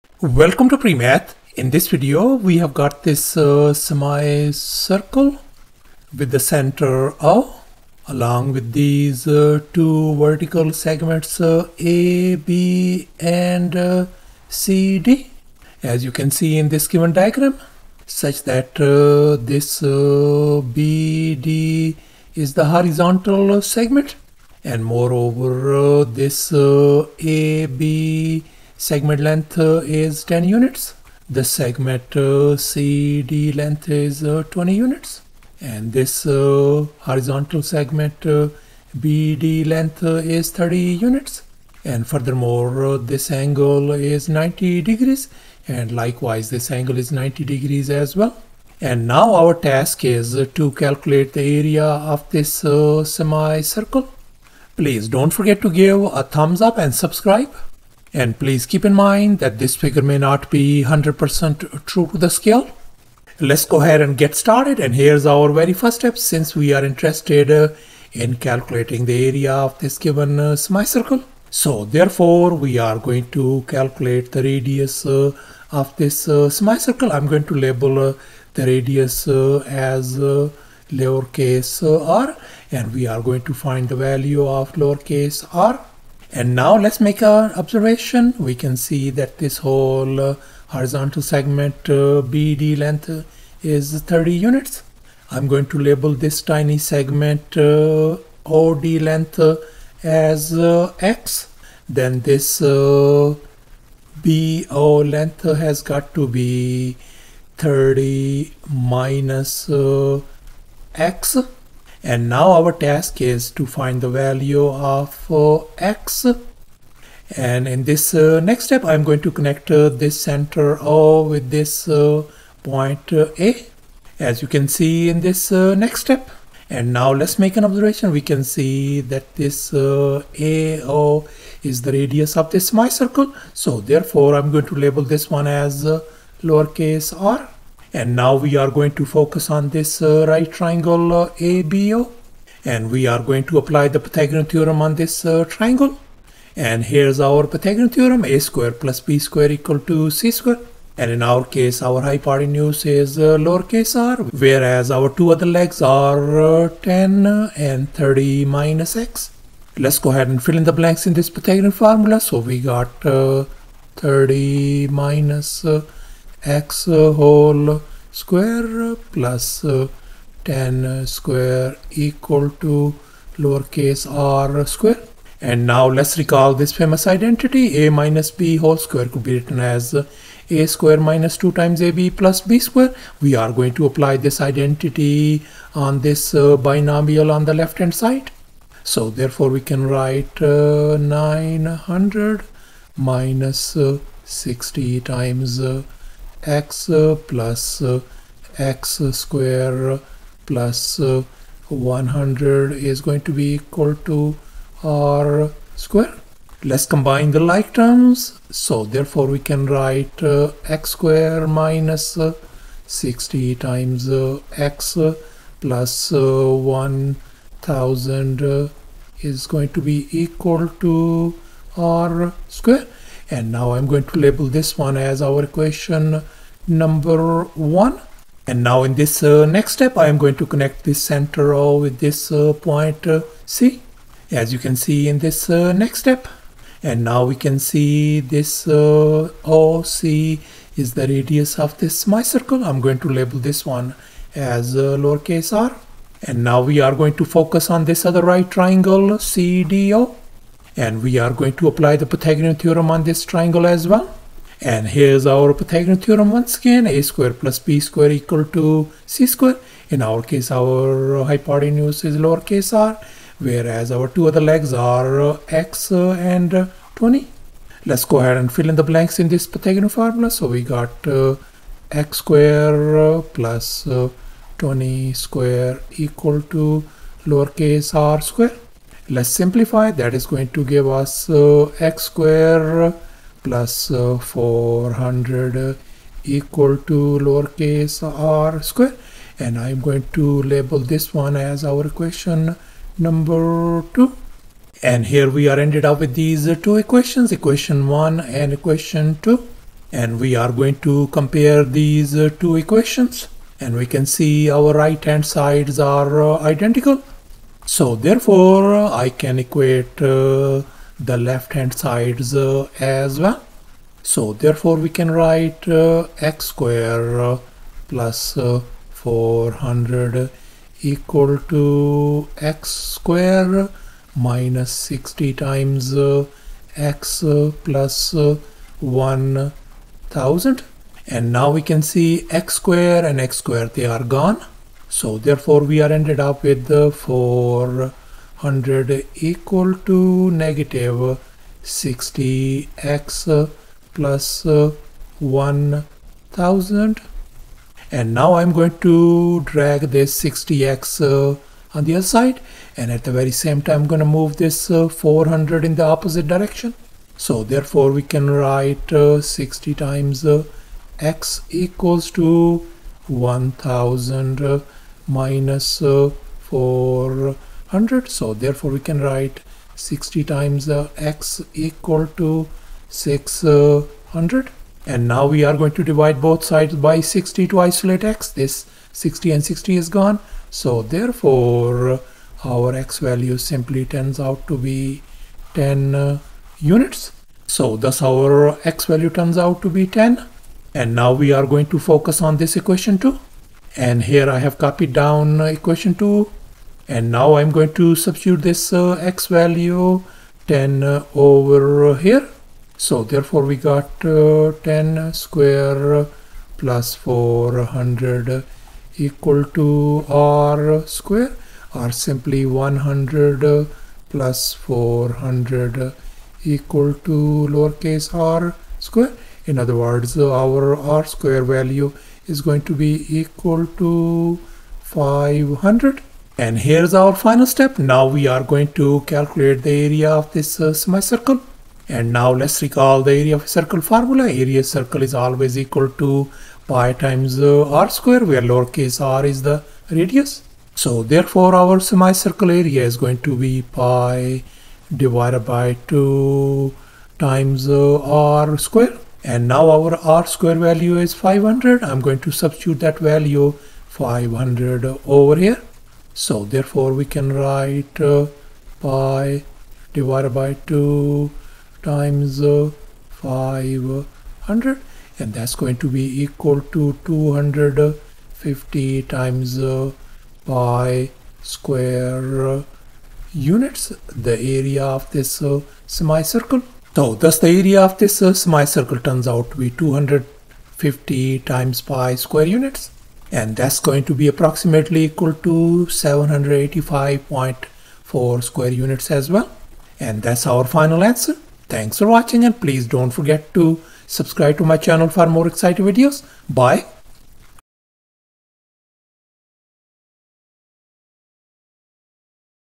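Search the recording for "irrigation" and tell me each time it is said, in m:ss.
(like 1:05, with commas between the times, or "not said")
not said.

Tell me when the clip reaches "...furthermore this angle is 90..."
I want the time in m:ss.
0:42.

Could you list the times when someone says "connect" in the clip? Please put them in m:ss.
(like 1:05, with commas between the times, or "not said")
1:59, 3:50.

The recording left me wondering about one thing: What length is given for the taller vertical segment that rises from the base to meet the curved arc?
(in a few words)
20 units.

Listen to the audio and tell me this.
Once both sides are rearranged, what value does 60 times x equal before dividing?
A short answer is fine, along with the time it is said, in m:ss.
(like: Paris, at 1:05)
600, at 6:12.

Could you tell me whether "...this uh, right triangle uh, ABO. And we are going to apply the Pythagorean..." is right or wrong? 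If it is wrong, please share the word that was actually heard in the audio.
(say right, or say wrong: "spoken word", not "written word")
right.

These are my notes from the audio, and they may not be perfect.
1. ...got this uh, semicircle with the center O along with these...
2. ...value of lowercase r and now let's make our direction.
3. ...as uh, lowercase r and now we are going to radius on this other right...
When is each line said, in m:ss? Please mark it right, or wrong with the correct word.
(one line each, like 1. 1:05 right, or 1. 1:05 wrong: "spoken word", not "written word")
1. 0:02 right
2. 1:23 wrong: "observation", not "direction"
3. 4:04 wrong: "focus", not "radius".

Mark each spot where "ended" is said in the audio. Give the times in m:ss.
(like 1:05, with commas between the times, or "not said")
4:55, 5:35.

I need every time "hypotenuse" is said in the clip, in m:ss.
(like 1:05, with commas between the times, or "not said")
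2:32, 4:21.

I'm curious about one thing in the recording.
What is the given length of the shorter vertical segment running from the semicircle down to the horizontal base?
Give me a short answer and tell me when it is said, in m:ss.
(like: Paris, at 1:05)
10 units, at 0:30.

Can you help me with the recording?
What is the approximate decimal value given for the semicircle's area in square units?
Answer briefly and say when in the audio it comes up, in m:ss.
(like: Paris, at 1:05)
785.4, at 8:05.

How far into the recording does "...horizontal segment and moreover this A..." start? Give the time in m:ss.
0:22.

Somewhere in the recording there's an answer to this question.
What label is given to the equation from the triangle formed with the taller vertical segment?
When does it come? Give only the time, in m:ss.
4:51.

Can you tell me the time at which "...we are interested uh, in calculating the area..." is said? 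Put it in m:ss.
1:06.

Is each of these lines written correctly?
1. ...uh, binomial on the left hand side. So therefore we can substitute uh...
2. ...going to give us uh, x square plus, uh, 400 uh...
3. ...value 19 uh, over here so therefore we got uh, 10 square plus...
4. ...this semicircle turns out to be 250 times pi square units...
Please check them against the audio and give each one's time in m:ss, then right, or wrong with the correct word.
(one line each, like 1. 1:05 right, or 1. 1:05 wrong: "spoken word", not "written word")
1. 3:06 wrong: "write", not "substitute"
2. 4:40 right
3. 6:39 wrong: "10", not "19"
4. 7:57 right.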